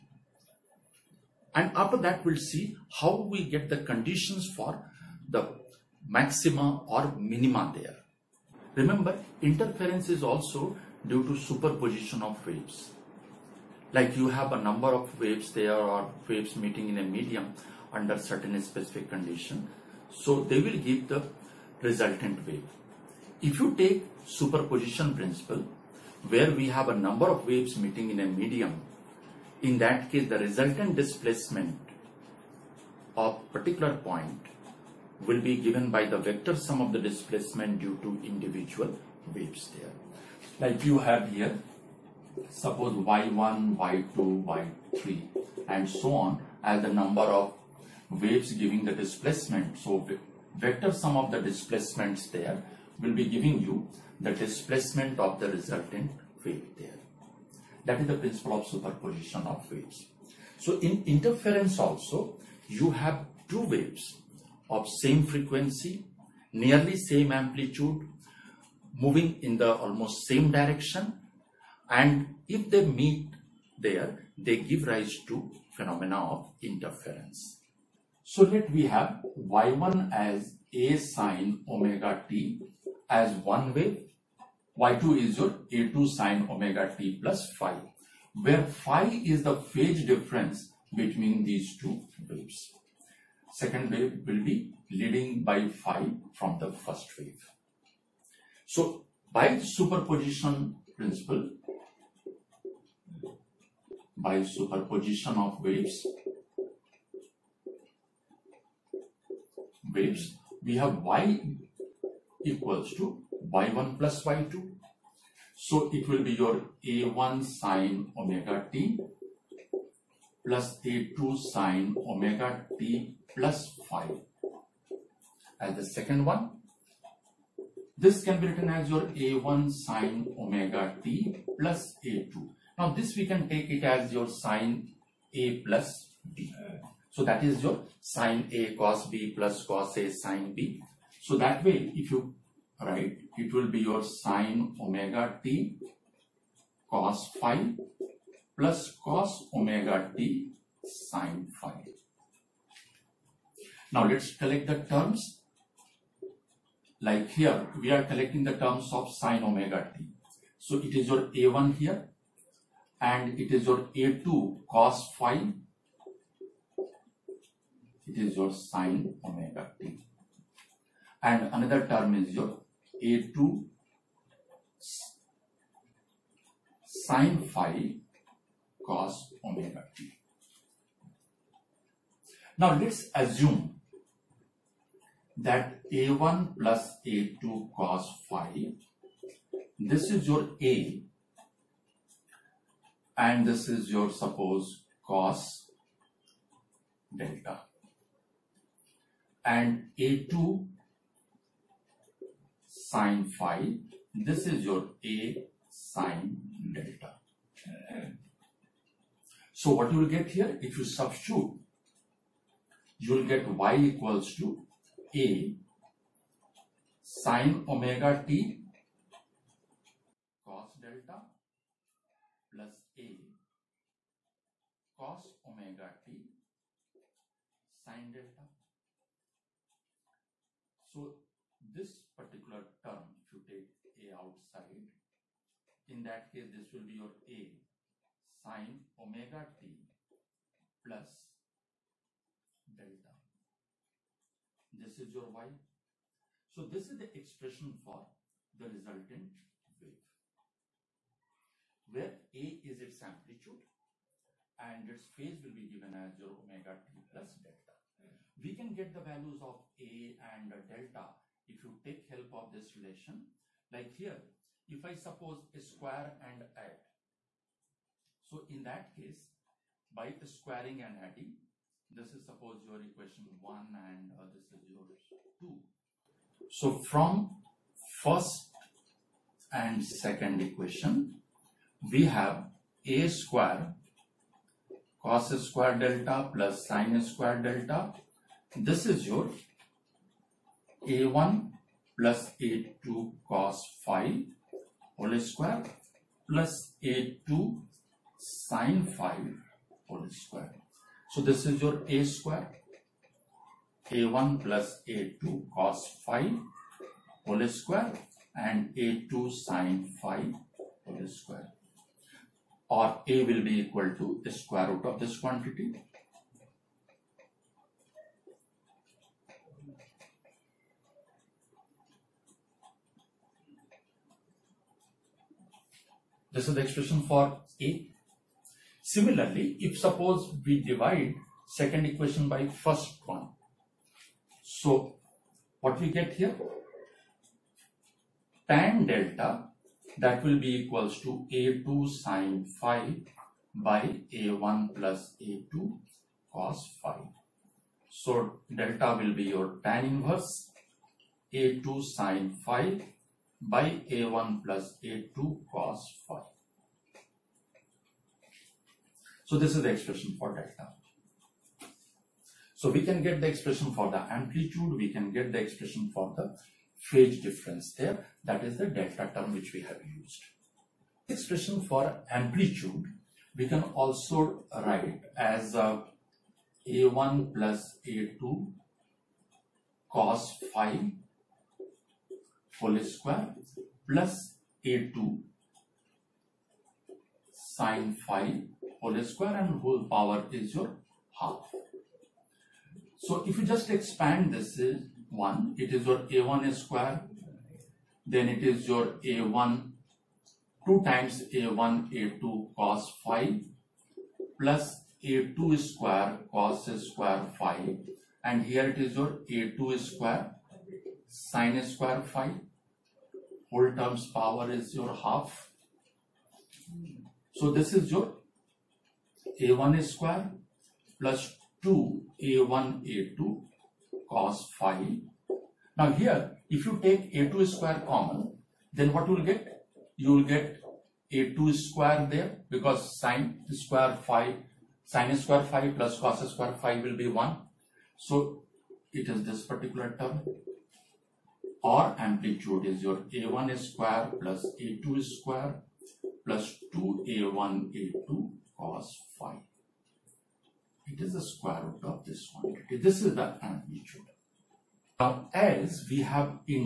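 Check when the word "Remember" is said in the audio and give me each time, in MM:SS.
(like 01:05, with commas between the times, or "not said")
00:08.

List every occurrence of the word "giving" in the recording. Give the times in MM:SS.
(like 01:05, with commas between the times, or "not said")
00:48, 00:53.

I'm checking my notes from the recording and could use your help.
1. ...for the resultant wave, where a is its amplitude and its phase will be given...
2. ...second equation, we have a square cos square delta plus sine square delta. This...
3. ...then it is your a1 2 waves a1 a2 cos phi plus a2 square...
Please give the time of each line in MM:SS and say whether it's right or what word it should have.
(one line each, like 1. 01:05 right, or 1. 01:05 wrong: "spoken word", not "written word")
1. 04:07 right
2. 04:39 right
3. 06:38 wrong: "times", not "waves".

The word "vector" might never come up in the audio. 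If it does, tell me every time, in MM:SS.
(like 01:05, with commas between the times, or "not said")
00:36, 00:50.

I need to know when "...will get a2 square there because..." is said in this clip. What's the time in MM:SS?
07:10.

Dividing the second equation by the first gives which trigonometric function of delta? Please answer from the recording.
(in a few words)
tan delta.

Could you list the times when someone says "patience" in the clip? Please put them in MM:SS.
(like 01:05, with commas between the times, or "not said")
not said.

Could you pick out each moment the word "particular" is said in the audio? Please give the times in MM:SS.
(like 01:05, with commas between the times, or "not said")
00:33, 03:52, 07:19.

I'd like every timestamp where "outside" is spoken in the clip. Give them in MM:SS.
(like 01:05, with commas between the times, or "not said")
03:54.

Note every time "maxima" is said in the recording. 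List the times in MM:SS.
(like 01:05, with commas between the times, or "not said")
00:06.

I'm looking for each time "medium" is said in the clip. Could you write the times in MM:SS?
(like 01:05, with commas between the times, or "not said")
00:17, 00:28.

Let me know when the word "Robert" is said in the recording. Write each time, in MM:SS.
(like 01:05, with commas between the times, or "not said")
not said.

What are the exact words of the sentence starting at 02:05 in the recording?
As the second one, this can be written as your a1 sine omega t plus a2.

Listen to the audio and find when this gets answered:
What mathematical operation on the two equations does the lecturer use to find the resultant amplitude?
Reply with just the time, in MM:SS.
04:30.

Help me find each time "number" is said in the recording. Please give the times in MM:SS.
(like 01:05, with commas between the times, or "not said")
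00:14, 00:26, 00:46.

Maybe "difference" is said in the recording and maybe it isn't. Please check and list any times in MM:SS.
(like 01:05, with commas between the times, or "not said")
01:30, 06:07.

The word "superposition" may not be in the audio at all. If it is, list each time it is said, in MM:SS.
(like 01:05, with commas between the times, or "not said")
00:11, 00:24, 00:58, 01:39, 01:44.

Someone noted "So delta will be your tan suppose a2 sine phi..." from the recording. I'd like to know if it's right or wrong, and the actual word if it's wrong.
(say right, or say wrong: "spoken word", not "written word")
wrong: "inverse", not "suppose".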